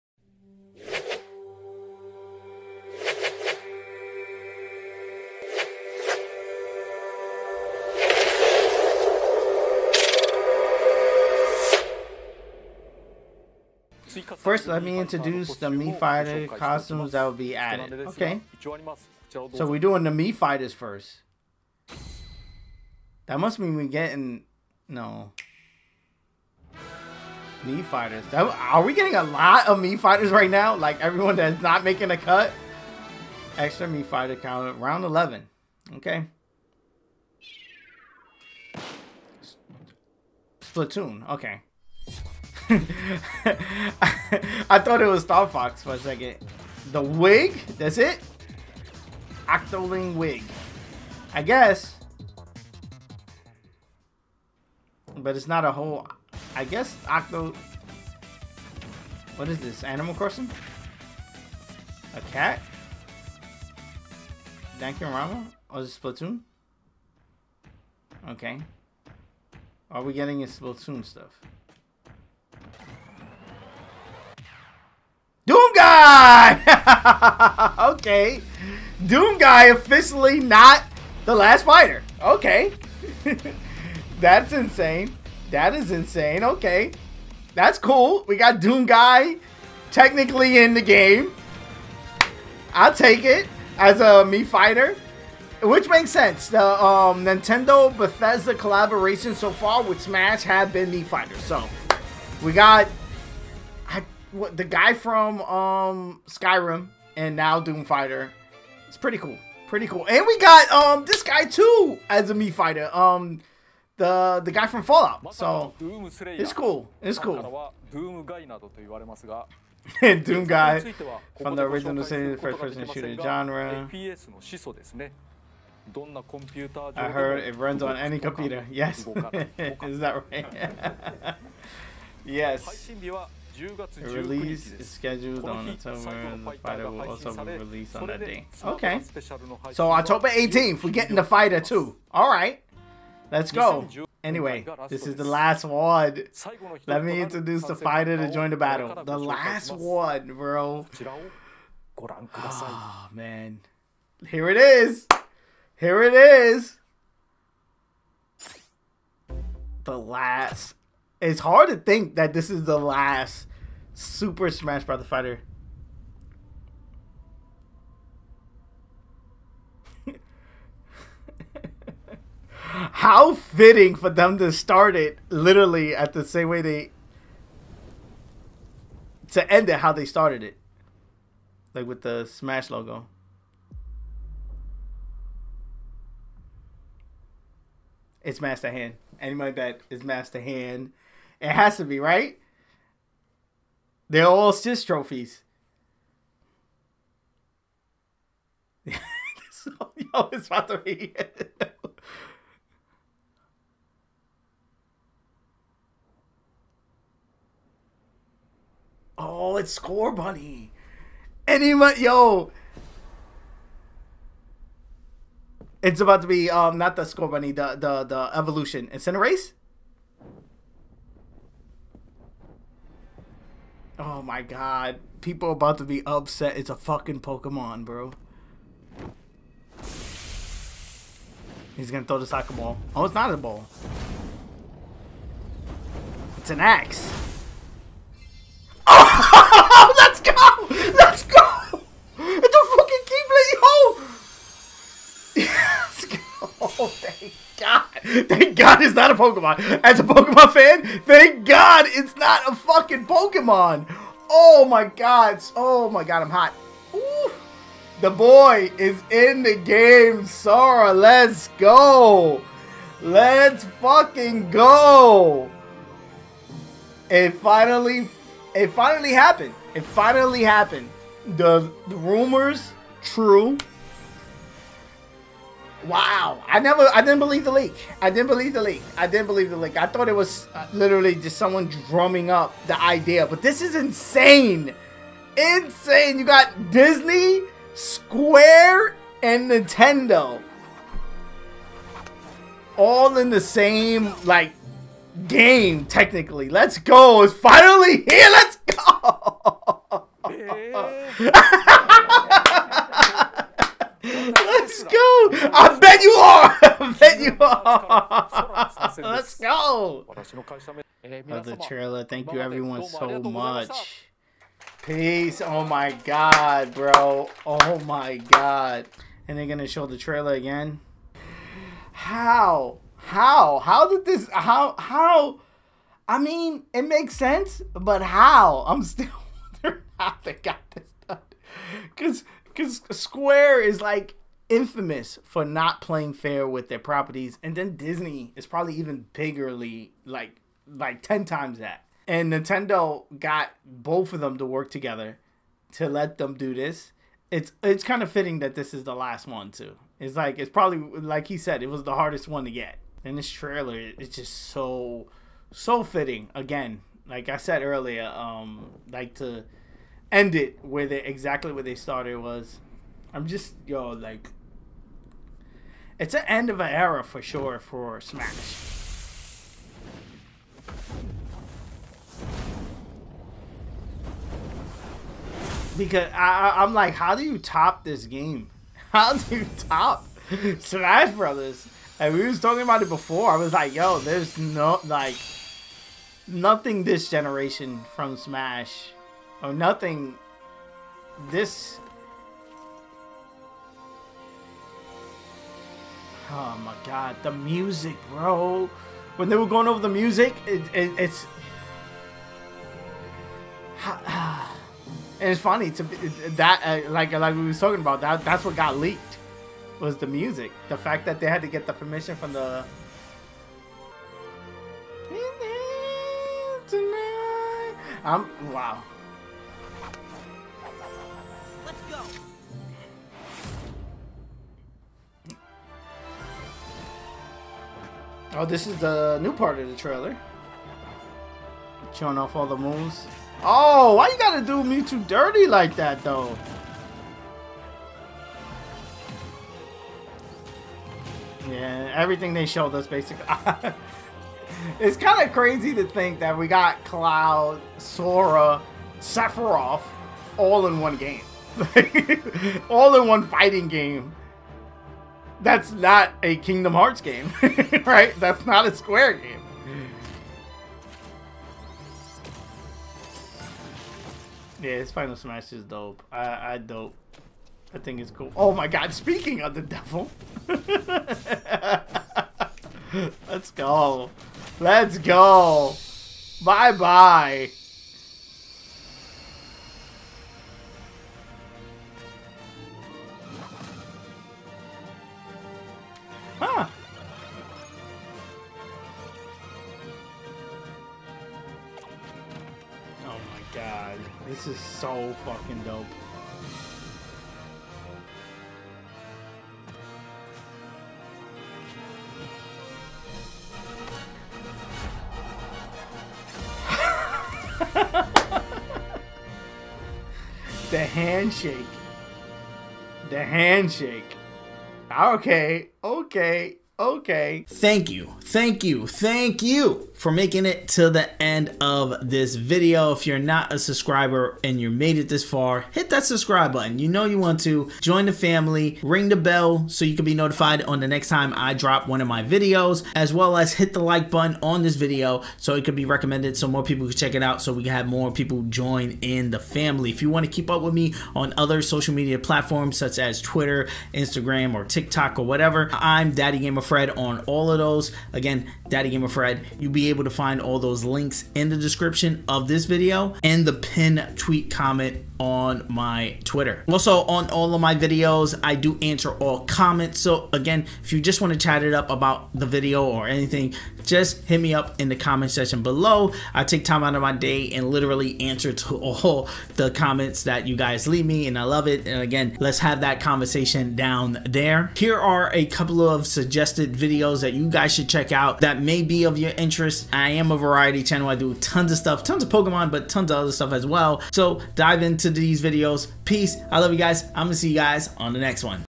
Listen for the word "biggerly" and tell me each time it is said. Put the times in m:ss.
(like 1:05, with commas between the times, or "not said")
5:39.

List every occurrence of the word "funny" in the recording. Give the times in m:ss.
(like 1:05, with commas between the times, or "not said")
6:45.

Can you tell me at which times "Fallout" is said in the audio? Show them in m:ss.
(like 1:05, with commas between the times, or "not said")
1:54.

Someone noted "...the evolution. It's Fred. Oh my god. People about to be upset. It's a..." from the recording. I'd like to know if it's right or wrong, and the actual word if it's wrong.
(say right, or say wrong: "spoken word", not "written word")
wrong: "Cinderace", not "Fred".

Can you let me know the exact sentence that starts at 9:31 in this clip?
And again, let's have that conversation down there.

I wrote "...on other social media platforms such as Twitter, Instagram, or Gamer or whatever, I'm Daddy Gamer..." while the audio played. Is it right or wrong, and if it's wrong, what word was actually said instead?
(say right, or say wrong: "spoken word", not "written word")
wrong: "TikTok", not "Gamer".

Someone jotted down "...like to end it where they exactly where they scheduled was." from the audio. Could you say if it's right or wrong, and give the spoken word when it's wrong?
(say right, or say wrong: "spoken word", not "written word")
wrong: "started", not "scheduled".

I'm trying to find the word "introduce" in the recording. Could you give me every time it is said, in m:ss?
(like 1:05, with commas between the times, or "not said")
0:14, 2:27.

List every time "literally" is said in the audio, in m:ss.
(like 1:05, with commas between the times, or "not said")
2:55, 4:40, 9:27.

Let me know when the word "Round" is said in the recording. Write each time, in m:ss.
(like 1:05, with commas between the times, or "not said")
0:34.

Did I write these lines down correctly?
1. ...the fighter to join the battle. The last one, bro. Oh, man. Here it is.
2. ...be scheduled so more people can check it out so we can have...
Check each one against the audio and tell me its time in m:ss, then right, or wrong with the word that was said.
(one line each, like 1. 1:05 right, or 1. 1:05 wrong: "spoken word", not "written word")
1. 2:27 right
2. 8:55 wrong: "recommended", not "scheduled".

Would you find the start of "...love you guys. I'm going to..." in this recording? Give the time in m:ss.
9:46.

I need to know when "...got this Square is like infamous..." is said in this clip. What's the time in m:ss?
5:30.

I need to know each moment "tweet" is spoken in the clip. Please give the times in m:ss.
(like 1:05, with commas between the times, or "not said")
9:14.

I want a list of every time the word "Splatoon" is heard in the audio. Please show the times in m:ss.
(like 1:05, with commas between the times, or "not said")
0:40, 1:06, 1:10.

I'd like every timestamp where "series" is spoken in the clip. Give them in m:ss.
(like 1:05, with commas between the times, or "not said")
2:02.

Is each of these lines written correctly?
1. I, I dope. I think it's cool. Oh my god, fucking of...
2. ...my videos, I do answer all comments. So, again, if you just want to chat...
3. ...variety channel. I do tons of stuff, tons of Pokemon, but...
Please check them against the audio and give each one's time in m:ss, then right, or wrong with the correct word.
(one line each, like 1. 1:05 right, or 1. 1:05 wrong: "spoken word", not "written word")
1. 7:46 wrong: "speaking", not "fucking"
2. 9:17 right
3. 9:40 right.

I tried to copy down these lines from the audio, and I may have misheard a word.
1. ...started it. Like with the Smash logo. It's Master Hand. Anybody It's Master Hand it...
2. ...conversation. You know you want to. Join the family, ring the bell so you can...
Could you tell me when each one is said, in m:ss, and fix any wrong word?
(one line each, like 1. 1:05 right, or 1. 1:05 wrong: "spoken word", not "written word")
1. 3:00 right
2. 8:46 wrong: "button", not "conversation".